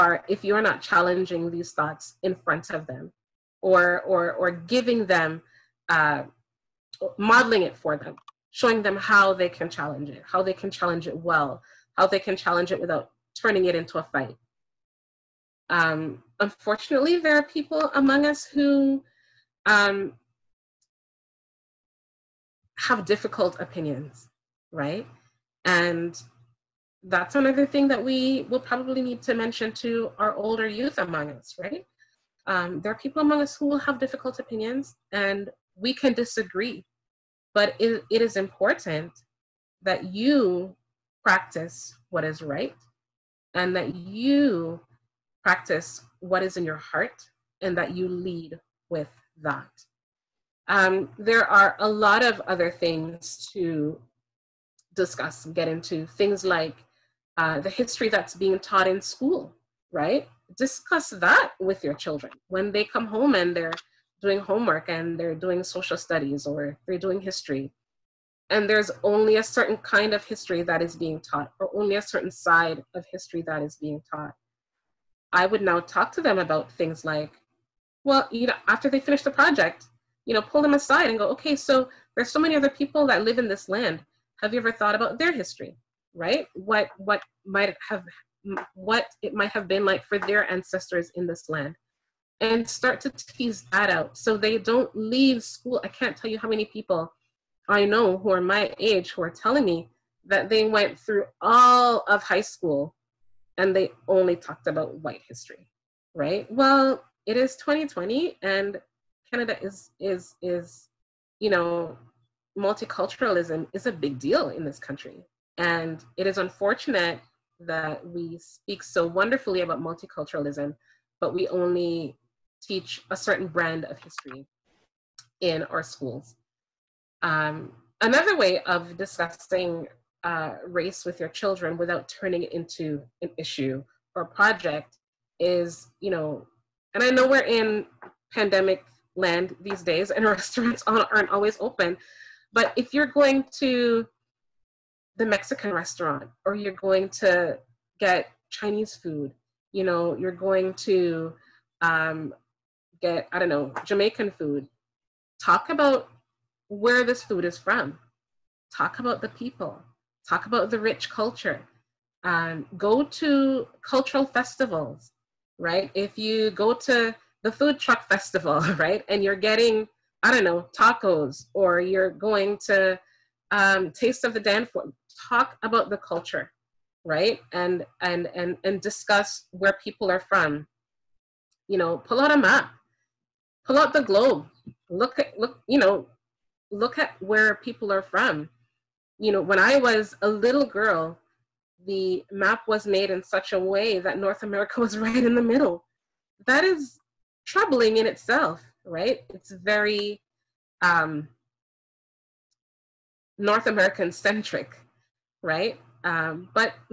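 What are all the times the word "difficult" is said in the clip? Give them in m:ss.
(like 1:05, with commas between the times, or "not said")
0:23, 0:33.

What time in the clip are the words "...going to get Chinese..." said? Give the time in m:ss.
2:26.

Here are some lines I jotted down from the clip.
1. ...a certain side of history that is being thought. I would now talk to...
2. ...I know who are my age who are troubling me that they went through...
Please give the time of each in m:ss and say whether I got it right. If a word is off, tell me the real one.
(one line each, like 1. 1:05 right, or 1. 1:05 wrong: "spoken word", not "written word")
1. 1:11 wrong: "taught", not "thought"
2. 1:37 wrong: "telling", not "troubling".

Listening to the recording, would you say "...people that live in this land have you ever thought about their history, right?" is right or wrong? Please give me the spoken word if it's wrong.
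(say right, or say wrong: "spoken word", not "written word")
right.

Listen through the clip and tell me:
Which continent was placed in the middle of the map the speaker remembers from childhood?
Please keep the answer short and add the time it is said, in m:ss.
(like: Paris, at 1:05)
North America, at 3:14.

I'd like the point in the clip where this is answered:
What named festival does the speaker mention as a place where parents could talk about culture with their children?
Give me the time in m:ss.
2:53.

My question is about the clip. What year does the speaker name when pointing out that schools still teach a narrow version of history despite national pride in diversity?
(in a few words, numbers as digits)
2020.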